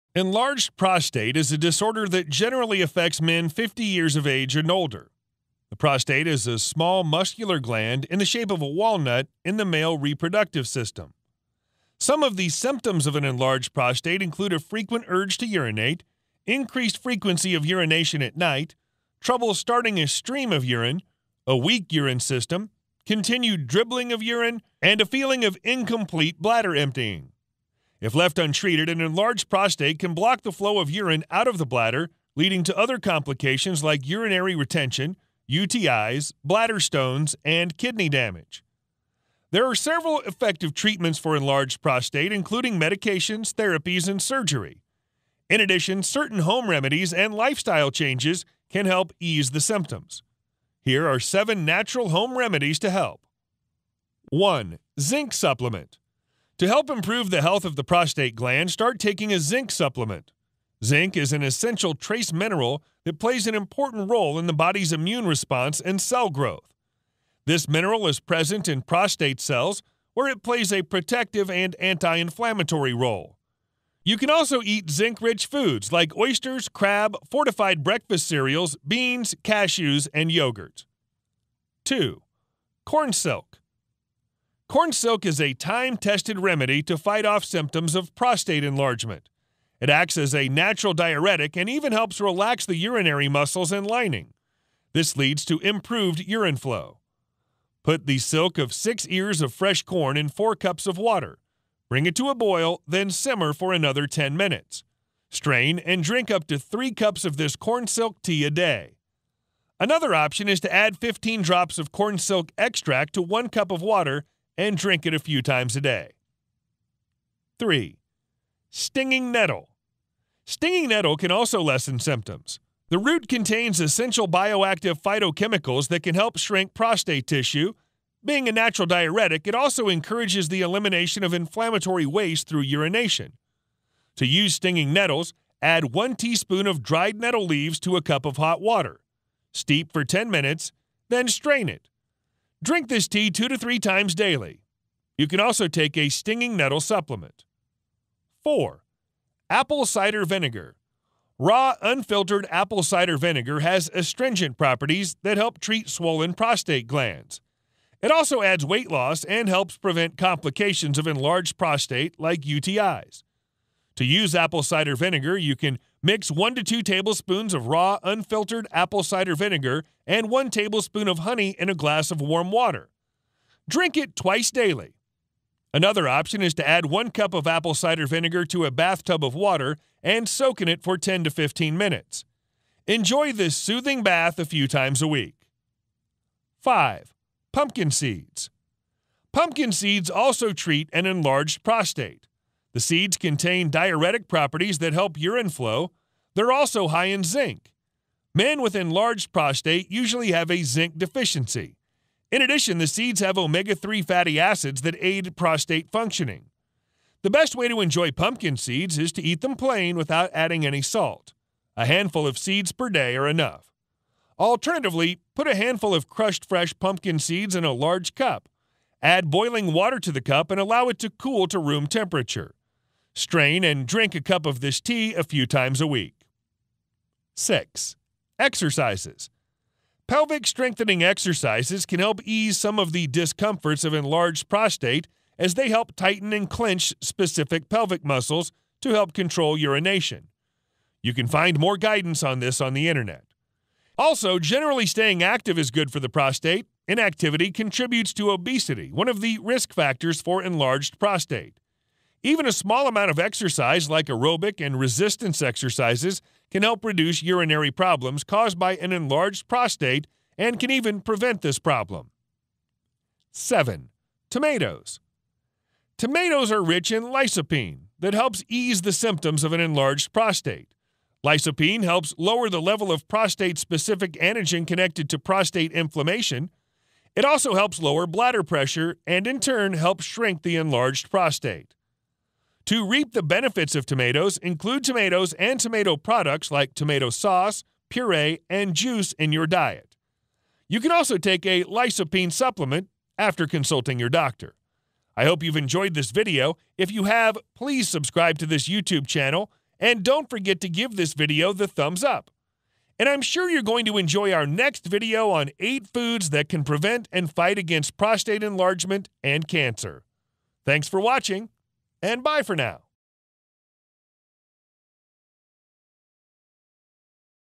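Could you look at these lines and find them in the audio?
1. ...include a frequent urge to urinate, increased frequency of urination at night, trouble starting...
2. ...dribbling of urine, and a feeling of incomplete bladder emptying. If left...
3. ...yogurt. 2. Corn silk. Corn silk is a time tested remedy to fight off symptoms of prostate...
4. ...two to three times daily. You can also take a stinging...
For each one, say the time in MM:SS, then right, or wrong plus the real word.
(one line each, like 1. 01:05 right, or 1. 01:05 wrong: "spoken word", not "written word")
1. 00:14 right
2. 00:23 right
3. 01:20 right
4. 02:23 right.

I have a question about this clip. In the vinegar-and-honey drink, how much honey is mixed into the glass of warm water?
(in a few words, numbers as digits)
1 tablespoon.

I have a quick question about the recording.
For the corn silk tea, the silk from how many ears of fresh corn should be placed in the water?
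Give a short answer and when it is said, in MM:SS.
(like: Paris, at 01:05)
6, at 01:38.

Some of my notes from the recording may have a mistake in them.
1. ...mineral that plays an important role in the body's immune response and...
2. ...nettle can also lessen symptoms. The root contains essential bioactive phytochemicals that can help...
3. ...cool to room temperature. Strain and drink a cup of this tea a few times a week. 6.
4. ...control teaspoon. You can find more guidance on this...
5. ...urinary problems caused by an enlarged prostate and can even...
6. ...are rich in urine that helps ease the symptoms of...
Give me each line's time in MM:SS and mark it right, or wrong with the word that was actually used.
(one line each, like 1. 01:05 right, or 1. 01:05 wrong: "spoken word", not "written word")
1. 01:02 right
2. 02:00 right
3. 03:41 right
4. 03:59 wrong: "urination", not "teaspoon"
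5. 04:17 right
6. 04:26 wrong: "lycopene", not "urine".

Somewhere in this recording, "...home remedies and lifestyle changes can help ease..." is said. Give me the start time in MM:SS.
00:46.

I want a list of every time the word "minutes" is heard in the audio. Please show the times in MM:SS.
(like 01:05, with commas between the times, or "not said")
01:44, 02:20, 03:01.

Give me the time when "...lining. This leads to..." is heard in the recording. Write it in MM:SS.
01:33.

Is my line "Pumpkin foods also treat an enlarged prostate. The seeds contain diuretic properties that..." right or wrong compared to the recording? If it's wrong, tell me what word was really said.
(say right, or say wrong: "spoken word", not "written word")
wrong: "seeds", not "foods".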